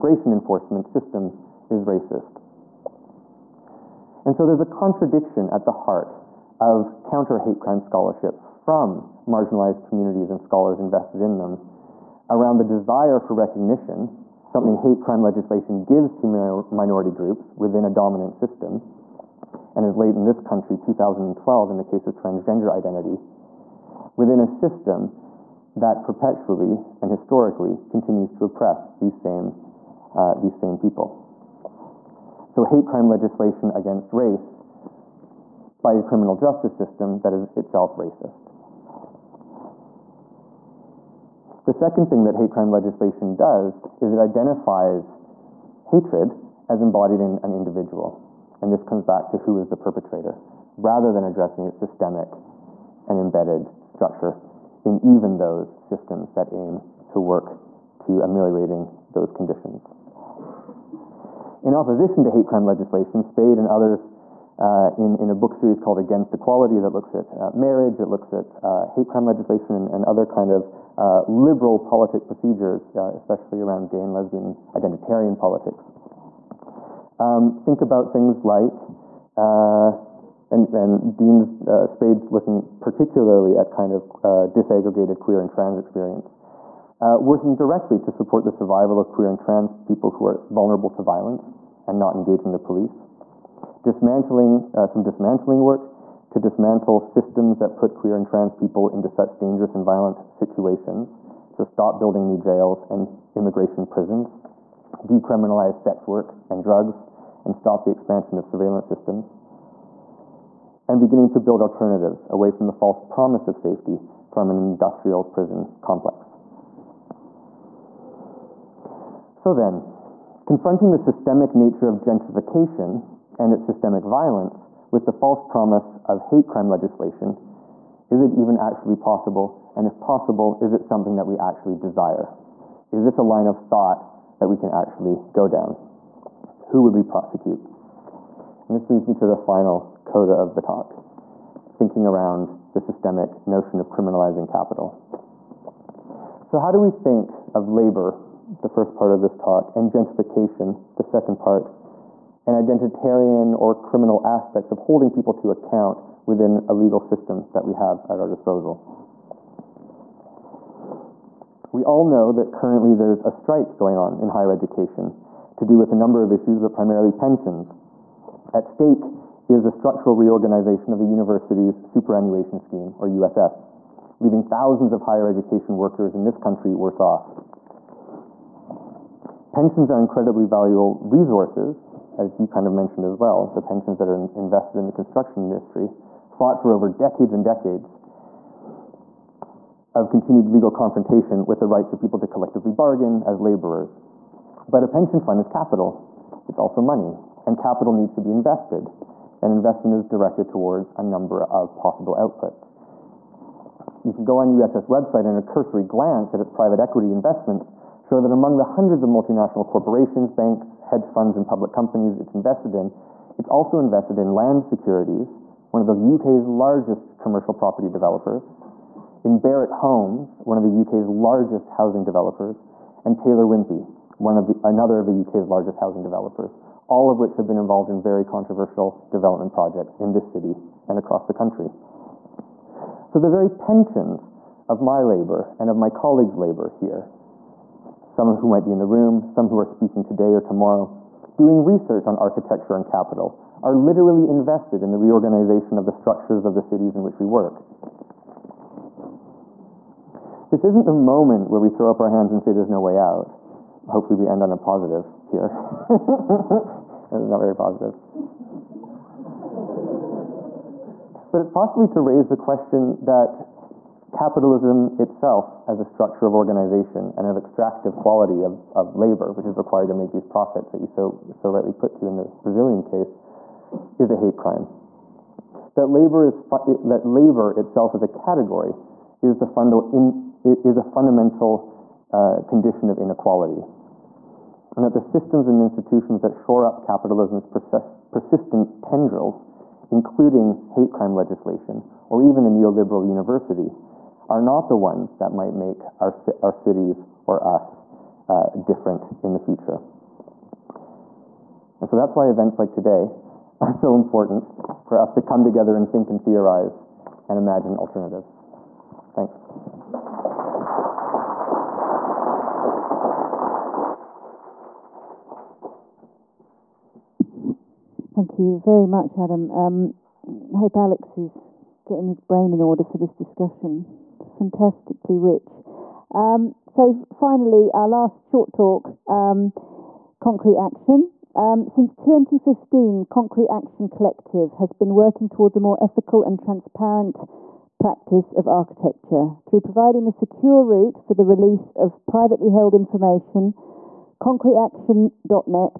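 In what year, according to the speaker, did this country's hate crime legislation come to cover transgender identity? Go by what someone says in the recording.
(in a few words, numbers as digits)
2012.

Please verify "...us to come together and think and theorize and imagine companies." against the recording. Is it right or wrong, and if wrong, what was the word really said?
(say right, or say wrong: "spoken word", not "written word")
wrong: "alternatives", not "companies".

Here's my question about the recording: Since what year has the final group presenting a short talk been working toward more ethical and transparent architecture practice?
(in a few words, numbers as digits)
2015.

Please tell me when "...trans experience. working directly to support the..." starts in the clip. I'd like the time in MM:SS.
01:25.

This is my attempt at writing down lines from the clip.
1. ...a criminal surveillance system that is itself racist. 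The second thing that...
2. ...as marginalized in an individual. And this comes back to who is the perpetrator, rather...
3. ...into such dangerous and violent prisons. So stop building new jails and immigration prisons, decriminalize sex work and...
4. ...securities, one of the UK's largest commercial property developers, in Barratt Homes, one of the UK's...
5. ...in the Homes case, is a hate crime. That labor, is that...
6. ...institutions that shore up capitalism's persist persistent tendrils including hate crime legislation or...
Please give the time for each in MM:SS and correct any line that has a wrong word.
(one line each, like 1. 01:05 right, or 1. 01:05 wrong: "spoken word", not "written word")
1. 00:35 wrong: "justice", not "surveillance"
2. 00:46 wrong: "embodied", not "marginalized"
3. 01:38 wrong: "situations", not "prisons"
4. 03:34 right
5. 04:32 wrong: "Brazilian", not "Homes"
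6. 04:45 right.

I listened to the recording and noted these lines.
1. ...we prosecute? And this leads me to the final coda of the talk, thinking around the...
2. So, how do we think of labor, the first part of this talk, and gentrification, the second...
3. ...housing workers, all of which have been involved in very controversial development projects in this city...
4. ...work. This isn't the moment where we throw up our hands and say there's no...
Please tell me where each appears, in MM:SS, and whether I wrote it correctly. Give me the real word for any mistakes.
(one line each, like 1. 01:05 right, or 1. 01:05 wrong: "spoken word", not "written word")
1. 02:16 right
2. 02:26 right
3. 03:45 wrong: "developers", not "workers"
4. 04:07 right.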